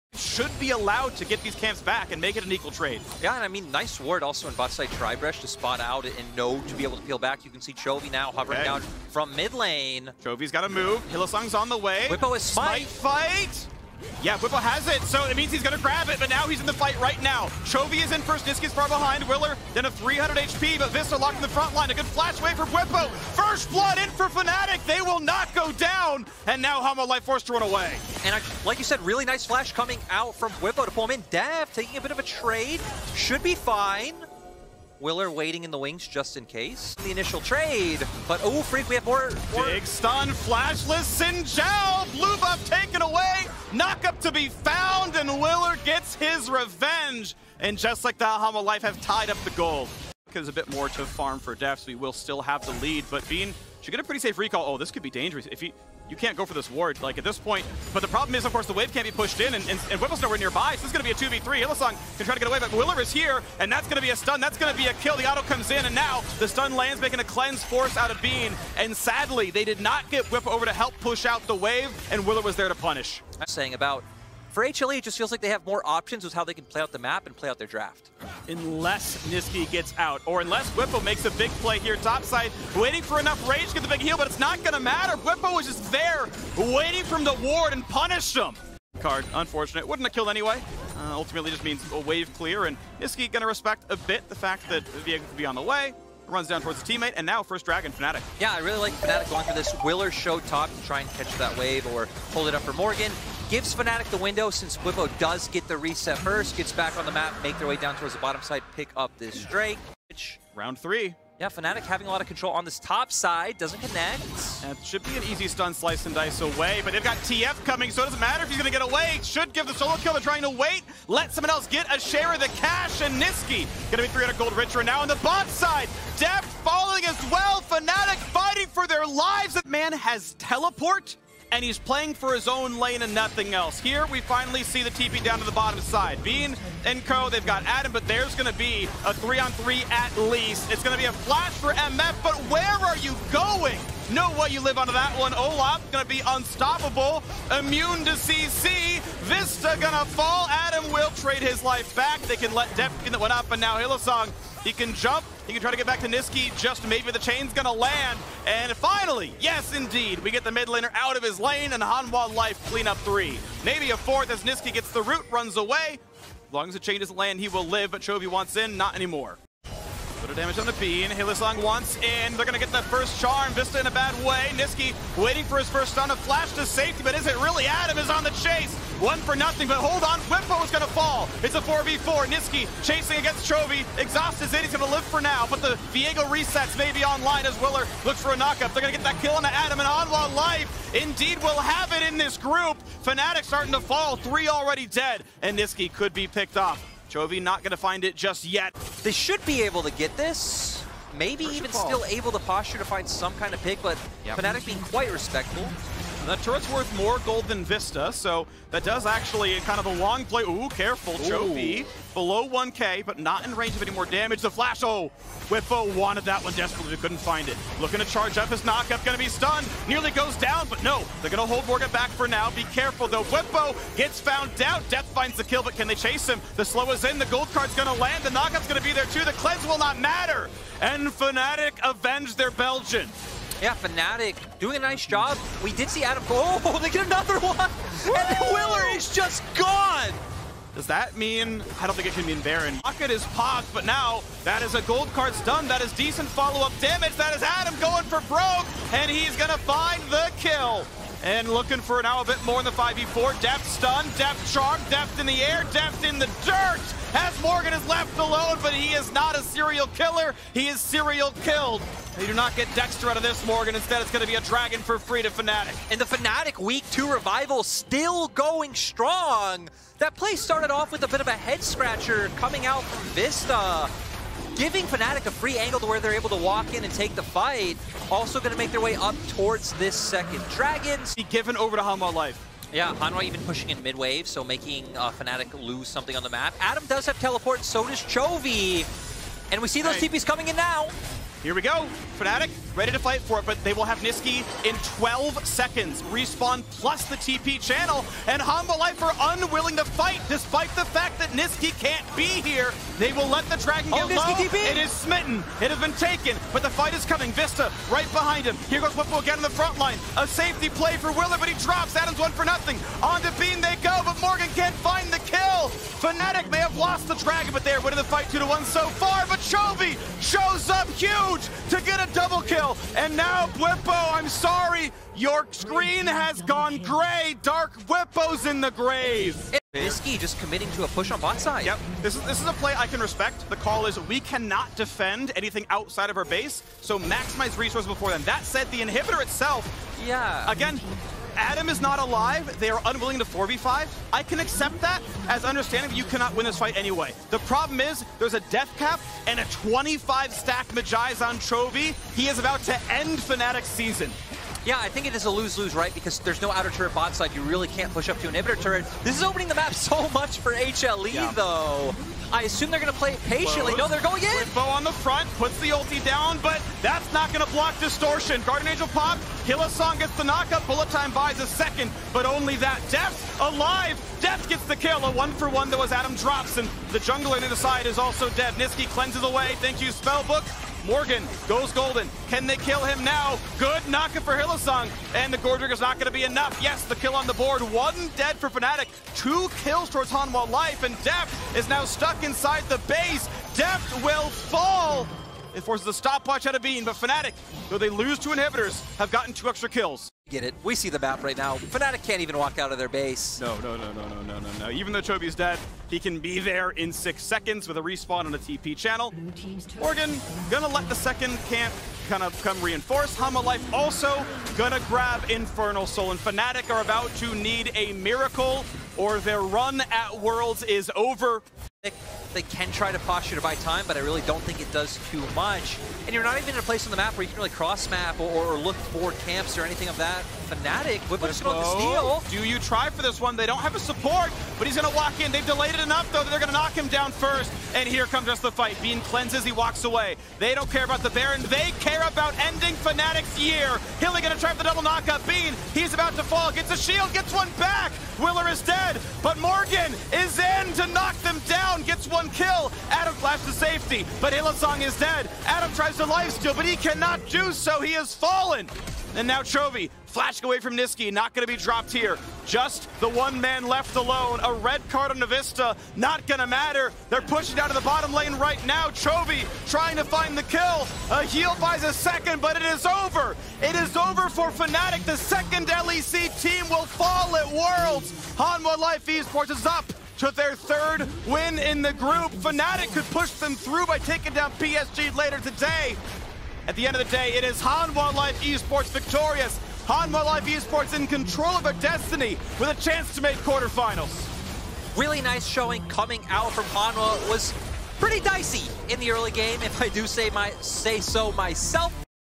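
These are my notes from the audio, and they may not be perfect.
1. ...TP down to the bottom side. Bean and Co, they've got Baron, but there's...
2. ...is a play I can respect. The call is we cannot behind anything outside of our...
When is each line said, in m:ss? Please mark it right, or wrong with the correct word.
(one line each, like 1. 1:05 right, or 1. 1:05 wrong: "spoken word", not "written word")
1. 2:14 wrong: "Adam", not "Baron"
2. 5:32 wrong: "defend", not "behind".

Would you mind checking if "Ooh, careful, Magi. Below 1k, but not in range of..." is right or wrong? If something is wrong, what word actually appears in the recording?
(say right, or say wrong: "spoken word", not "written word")
wrong: "Chovy", not "Magi".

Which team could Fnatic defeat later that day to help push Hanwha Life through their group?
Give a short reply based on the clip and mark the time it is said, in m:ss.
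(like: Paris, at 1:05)
PSG, at 8:04.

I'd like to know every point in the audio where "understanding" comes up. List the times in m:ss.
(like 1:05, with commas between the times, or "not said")
5:45.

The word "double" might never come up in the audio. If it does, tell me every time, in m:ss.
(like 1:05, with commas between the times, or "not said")
5:22, 7:24.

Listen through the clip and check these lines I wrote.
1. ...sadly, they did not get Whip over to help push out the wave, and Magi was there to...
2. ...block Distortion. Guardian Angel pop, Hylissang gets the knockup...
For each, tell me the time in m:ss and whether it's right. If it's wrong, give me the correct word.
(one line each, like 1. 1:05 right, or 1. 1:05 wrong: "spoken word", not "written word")
1. 1:08 wrong: "Willer", not "Magi"
2. 6:07 right.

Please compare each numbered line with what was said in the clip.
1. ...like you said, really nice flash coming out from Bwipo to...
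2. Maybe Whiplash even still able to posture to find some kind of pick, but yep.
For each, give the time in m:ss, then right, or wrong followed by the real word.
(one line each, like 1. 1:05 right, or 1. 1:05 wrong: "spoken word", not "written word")
1. 0:28 right
2. 3:21 wrong: "First", not "Whiplash".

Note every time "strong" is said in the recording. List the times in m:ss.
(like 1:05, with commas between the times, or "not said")
4:28.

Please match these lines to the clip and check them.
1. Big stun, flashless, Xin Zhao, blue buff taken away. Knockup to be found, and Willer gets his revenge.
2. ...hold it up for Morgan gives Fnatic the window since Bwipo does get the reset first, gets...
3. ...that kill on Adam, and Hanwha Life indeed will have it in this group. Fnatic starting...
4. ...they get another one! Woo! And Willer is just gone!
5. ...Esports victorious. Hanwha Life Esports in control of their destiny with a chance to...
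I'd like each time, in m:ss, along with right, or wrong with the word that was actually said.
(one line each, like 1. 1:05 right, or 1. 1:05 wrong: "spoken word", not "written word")
1. 0:39 right
2. 1:42 right
3. 3:09 right
4. 3:56 right
5. 8:08 right.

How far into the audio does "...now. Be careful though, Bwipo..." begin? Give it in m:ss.
3:42.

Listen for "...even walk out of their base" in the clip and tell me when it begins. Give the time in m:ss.
6:42.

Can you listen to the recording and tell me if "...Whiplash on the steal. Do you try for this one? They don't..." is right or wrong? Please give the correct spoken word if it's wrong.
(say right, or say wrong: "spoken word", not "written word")
right.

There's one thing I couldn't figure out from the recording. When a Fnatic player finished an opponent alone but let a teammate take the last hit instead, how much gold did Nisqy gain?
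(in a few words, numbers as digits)
300 gold.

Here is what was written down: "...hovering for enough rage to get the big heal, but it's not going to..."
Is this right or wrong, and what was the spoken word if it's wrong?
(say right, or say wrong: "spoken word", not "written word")
wrong: "waiting", not "hovering".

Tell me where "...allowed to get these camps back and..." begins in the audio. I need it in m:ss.
0:00.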